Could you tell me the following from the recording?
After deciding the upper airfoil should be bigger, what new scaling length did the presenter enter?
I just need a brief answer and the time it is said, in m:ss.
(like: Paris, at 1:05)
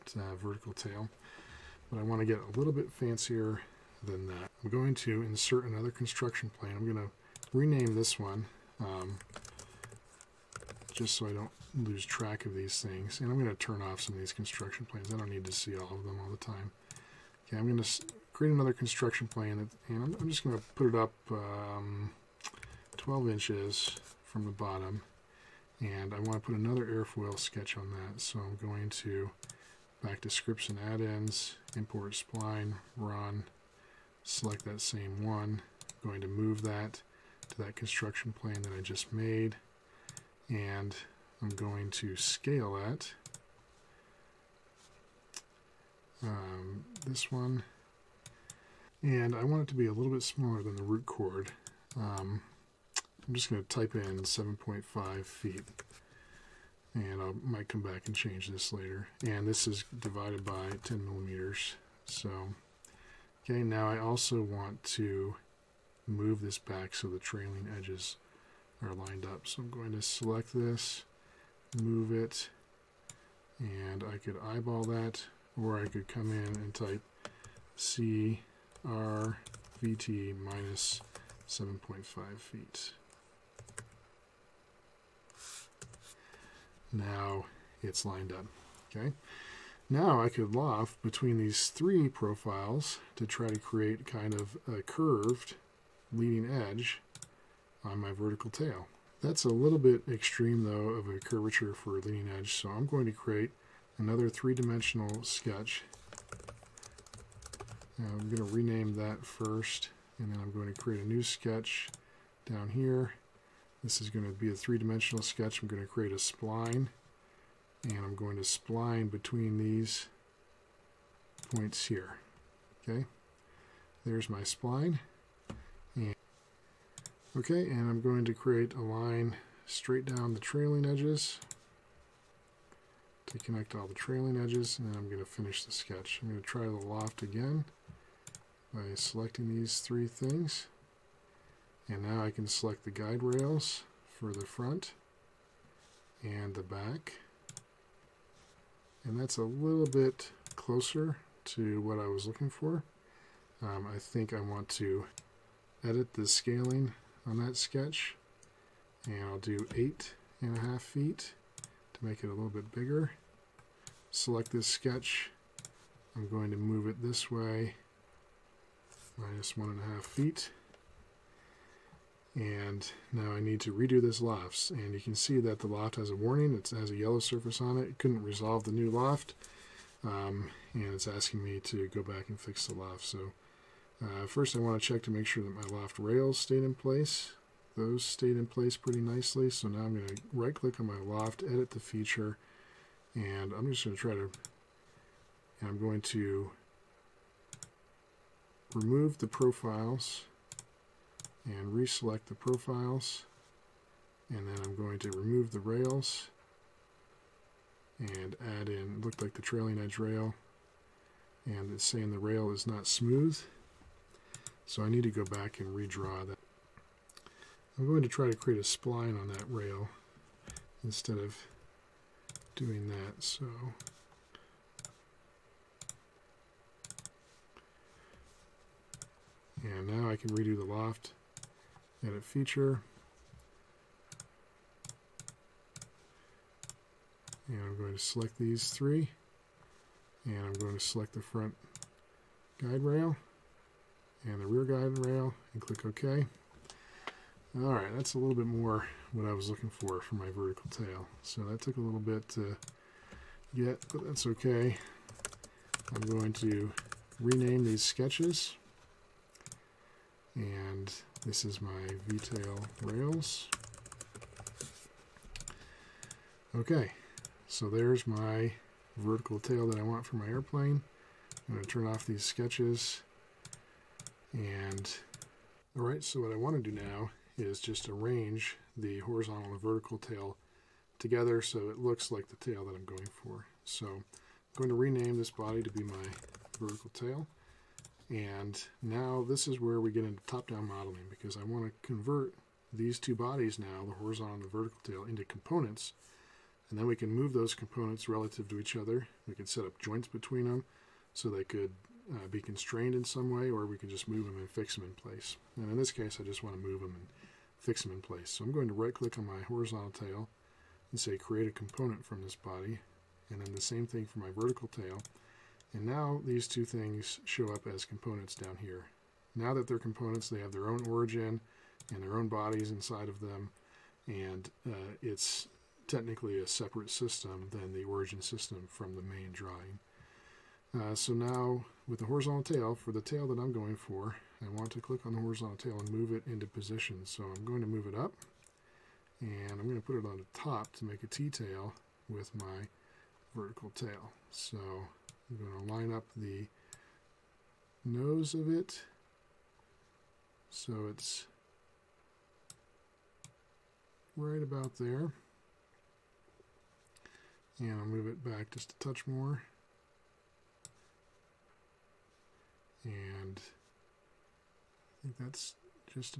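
8.5 feet, at 2:39.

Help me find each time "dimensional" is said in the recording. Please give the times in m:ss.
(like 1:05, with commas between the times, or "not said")
1:44, 1:54.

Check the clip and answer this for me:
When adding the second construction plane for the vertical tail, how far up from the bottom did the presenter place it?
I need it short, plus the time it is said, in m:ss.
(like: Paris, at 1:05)
12 inches, at 0:22.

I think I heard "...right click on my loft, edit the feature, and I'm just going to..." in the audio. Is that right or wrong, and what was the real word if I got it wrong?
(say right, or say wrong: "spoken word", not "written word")
right.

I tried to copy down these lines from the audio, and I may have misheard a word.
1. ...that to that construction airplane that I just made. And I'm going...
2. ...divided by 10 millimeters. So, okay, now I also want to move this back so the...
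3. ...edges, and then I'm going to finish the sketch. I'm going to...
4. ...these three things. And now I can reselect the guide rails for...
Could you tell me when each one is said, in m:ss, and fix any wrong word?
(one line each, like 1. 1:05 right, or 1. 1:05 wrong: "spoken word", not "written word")
1. 0:36 wrong: "plane", not "airplane"
2. 0:59 right
3. 2:14 right
4. 2:19 wrong: "select", not "reselect".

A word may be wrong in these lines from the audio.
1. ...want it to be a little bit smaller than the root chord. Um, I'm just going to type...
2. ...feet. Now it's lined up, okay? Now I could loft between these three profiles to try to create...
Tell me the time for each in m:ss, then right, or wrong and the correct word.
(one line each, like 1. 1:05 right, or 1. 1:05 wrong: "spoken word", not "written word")
1. 0:49 right
2. 1:22 right.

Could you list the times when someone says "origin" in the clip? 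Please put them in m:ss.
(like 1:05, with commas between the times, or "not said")
5:20, 5:27.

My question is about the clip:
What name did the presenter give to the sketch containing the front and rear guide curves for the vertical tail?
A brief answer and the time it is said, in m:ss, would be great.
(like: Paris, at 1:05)
V-tail rails, at 4:22.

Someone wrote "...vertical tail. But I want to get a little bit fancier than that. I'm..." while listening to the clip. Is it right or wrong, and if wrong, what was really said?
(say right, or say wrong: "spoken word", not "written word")
right.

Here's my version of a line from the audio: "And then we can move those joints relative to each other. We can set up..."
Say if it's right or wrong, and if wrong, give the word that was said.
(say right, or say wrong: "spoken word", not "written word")
wrong: "components", not "joints".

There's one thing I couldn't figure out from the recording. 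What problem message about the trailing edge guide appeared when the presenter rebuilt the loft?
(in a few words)
the rail is not smooth.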